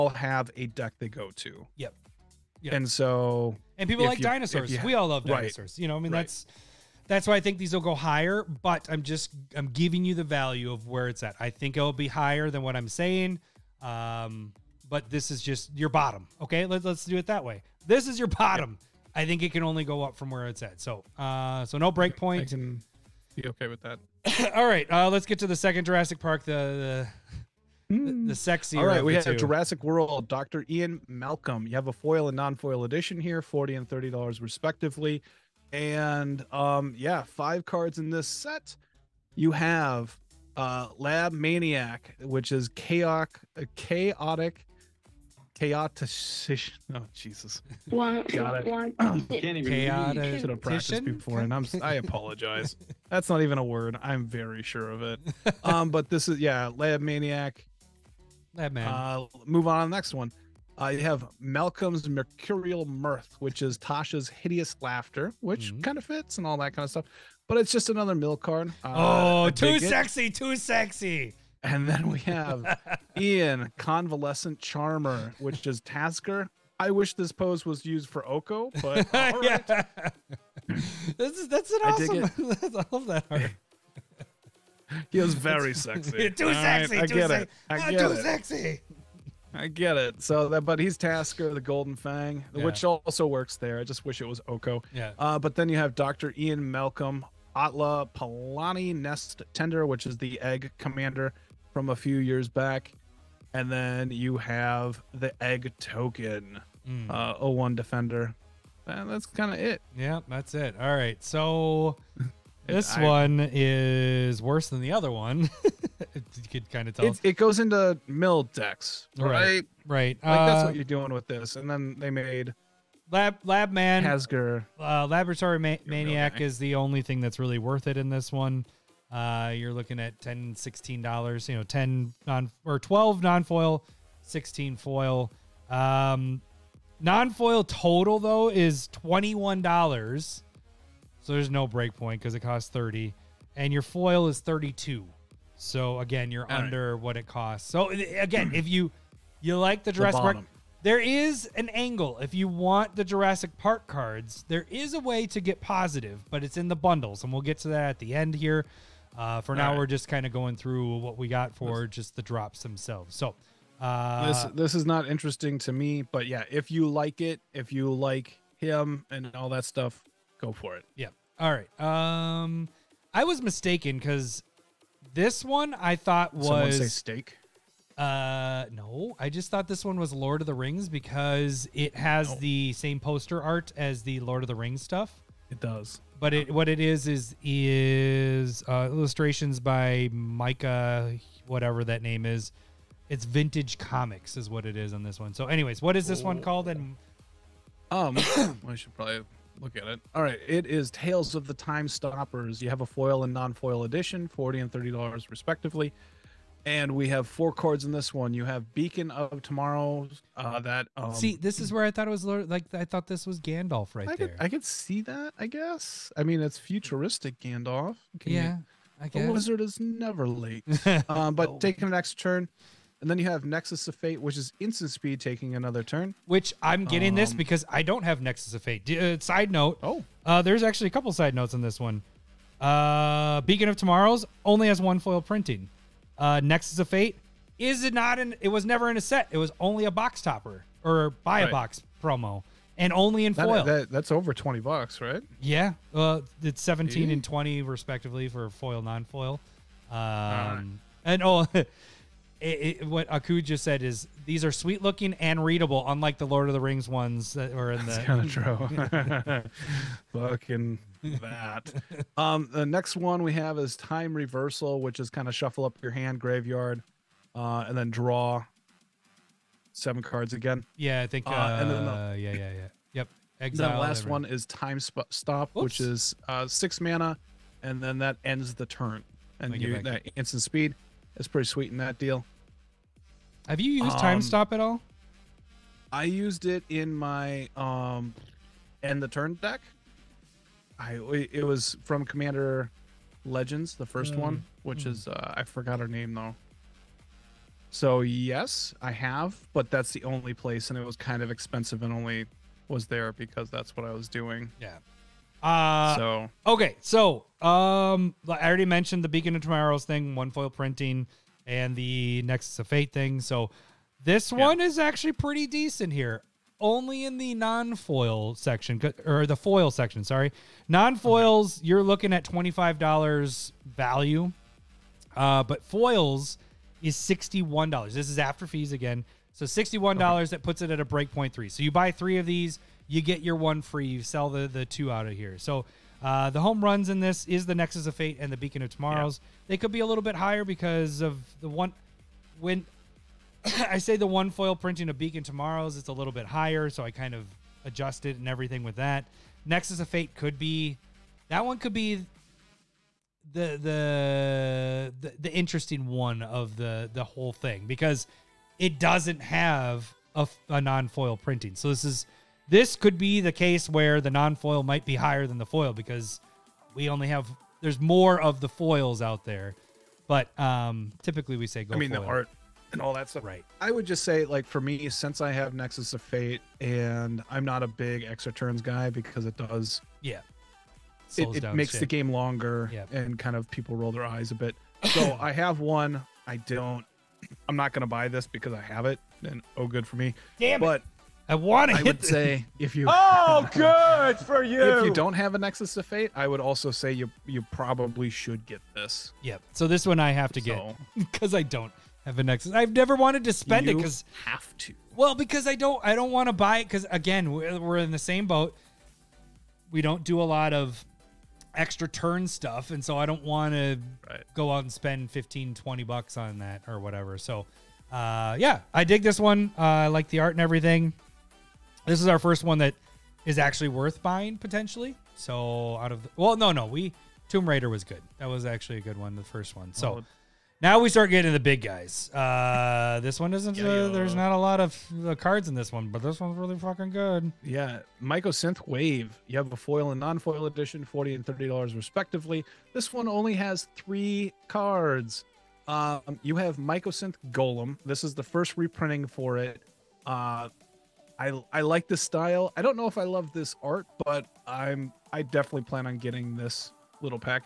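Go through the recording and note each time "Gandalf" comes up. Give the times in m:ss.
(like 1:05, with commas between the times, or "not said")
3:33, 3:37.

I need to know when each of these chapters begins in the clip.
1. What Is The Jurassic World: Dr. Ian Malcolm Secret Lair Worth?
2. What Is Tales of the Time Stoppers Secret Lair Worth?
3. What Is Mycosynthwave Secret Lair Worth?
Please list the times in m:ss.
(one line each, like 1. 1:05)
1. 0:29
2. 2:52
3. 7:11.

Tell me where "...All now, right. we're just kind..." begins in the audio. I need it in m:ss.
2:39.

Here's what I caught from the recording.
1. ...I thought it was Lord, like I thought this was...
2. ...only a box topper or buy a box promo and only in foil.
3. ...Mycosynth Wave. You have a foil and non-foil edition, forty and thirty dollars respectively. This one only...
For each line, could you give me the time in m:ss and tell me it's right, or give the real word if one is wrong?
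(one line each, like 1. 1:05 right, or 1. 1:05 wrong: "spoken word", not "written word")
1. 3:31 right
2. 3:59 right
3. 7:18 right.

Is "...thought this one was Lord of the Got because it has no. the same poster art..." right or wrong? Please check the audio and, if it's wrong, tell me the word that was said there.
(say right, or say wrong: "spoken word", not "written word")
wrong: "Rings", not "Got".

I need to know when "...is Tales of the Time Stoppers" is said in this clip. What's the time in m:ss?
3:20.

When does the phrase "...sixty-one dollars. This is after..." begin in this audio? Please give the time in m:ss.
5:26.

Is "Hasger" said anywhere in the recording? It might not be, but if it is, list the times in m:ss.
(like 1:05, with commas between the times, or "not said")
2:04.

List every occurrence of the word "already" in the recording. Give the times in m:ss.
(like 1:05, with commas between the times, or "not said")
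5:08.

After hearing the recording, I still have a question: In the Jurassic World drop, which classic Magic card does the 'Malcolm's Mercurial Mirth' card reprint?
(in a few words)
Tasha's Hideous Laughter.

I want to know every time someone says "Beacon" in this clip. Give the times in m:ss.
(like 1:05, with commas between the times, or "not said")
3:28, 3:53, 5:09, 5:38, 5:44.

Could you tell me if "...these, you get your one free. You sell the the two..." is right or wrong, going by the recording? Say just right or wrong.
right.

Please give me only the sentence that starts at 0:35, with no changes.
And um, yeah, five cards in this set.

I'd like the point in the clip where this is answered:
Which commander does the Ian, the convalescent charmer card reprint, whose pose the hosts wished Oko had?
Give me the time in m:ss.
1:30.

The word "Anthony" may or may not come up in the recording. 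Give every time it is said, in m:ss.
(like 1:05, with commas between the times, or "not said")
not said.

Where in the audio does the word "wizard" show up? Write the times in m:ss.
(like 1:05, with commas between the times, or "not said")
3:39.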